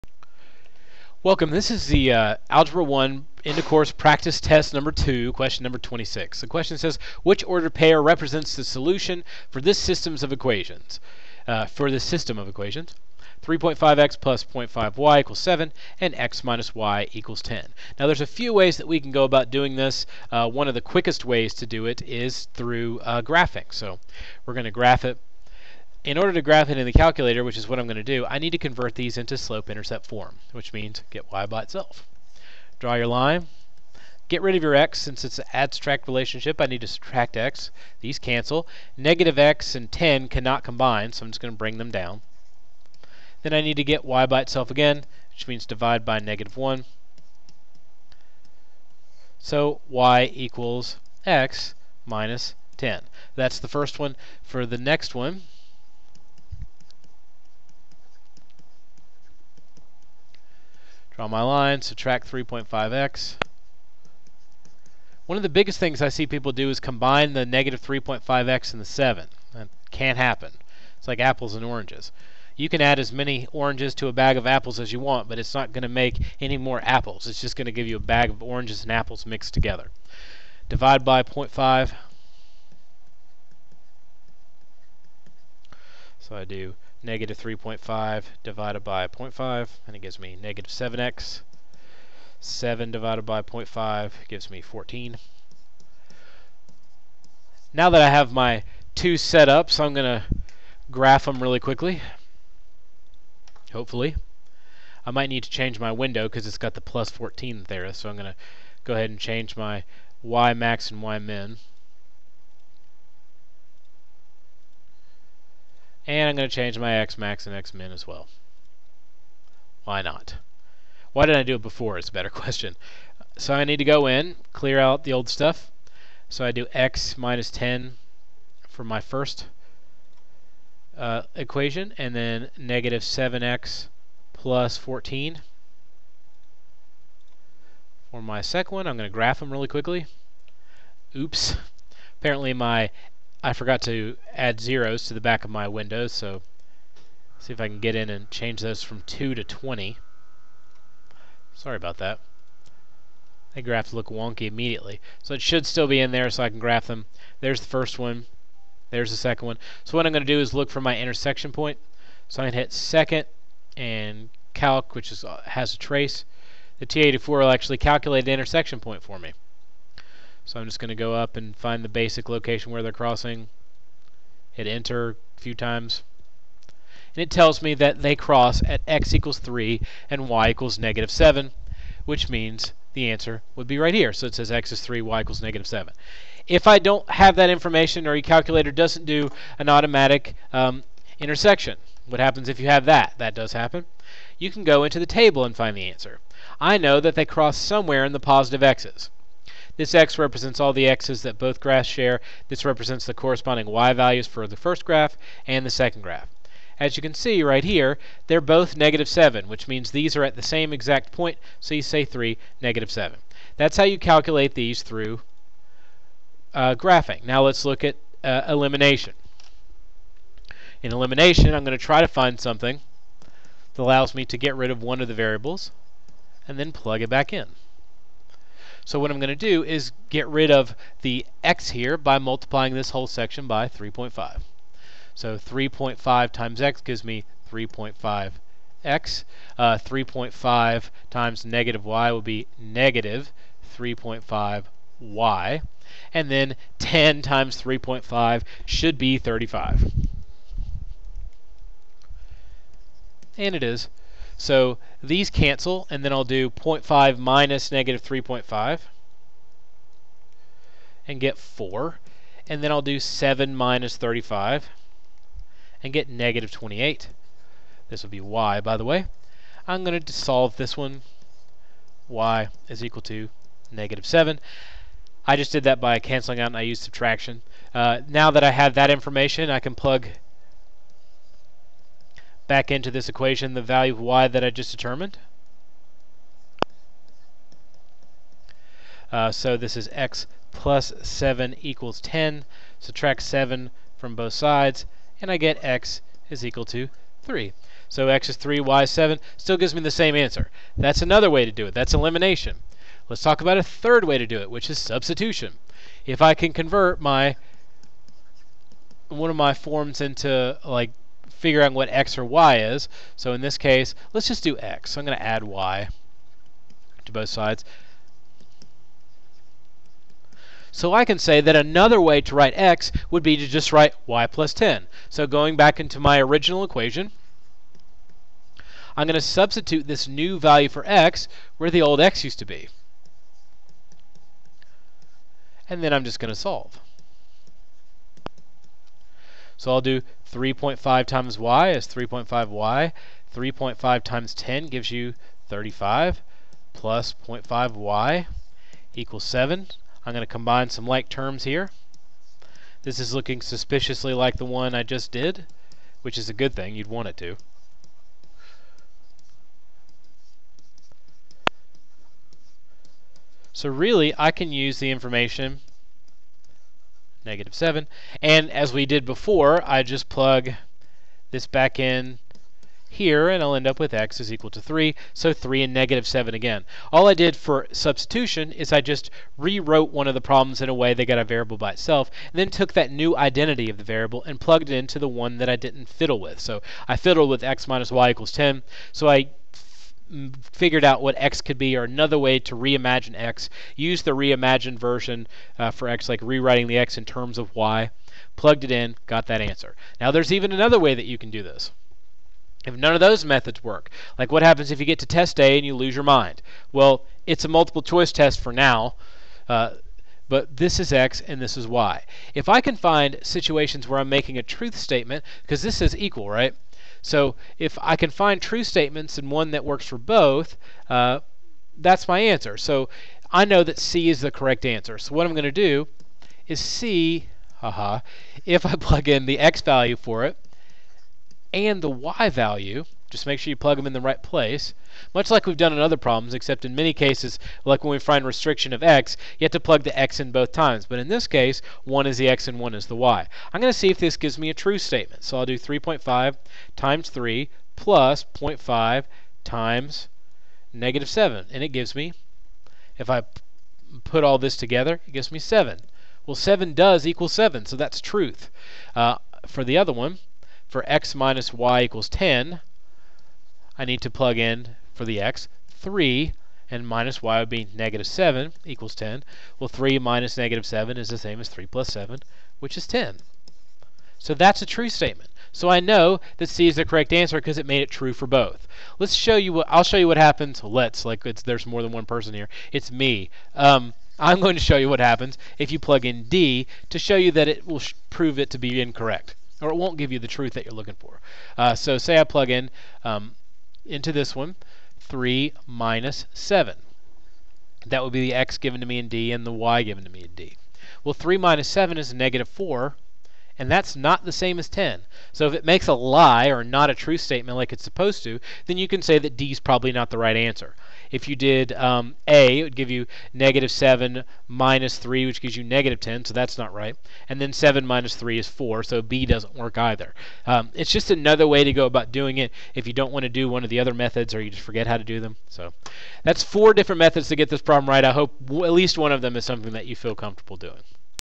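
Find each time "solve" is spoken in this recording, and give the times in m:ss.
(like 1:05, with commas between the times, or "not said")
4:30, 5:36.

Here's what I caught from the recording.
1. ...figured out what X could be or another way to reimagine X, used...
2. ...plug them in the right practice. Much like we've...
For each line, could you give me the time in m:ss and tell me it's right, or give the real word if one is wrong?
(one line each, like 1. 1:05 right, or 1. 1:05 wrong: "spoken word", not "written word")
1. 6:30 right
2. 7:13 wrong: "place", not "practice".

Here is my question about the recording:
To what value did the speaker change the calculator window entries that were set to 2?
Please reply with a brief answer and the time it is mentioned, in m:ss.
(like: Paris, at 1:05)
20, at 2:29.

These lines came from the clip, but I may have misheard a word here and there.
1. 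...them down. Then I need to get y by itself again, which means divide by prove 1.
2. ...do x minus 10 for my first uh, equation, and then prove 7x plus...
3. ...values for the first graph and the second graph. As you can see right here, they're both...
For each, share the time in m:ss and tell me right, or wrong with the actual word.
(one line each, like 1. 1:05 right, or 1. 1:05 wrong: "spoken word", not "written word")
1. 0:41 wrong: "negative", not "prove"
2. 2:06 wrong: "negative", not "prove"
3. 3:23 right.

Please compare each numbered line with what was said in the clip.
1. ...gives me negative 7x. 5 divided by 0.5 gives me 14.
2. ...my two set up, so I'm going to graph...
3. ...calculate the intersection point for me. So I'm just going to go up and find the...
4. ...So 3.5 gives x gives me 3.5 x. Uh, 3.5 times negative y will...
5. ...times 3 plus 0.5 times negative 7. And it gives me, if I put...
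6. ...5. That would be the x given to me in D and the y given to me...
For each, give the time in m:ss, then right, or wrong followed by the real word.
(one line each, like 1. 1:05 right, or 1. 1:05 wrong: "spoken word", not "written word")
1. 1:30 wrong: "7", not "5"
2. 1:38 right
3. 2:47 right
4. 3:55 wrong: "times", not "gives"
5. 7:26 right
6. 8:16 wrong: "7", not "5".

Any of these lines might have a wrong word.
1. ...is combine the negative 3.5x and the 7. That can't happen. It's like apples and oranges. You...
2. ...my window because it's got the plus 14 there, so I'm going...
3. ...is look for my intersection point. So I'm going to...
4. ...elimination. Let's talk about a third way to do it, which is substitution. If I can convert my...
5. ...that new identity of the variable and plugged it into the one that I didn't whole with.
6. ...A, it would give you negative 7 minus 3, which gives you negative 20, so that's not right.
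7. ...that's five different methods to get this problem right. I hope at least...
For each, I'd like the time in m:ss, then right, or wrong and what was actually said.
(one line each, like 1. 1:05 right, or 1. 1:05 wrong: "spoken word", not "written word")
1. 1:06 right
2. 1:45 right
3. 2:40 right
4. 5:01 right
5. 6:22 wrong: "fiddle", not "whole"
6. 8:32 wrong: "10", not "20"
7. 8:46 wrong: "four", not "five".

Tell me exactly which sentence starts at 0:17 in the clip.
Now there's a few ways that we can go about doing this.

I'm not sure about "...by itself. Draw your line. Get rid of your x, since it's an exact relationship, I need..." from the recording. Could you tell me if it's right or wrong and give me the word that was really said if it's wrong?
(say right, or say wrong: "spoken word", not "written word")
wrong: "abstract", not "exact".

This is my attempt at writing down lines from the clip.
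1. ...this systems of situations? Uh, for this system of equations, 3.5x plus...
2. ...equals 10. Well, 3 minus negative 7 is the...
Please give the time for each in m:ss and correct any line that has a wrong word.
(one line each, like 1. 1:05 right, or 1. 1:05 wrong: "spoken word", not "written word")
1. 0:09 wrong: "equations", not "situations"
2. 7:48 right.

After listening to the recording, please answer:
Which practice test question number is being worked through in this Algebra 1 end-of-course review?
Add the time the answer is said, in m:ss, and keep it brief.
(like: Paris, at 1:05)
26, at 0:05.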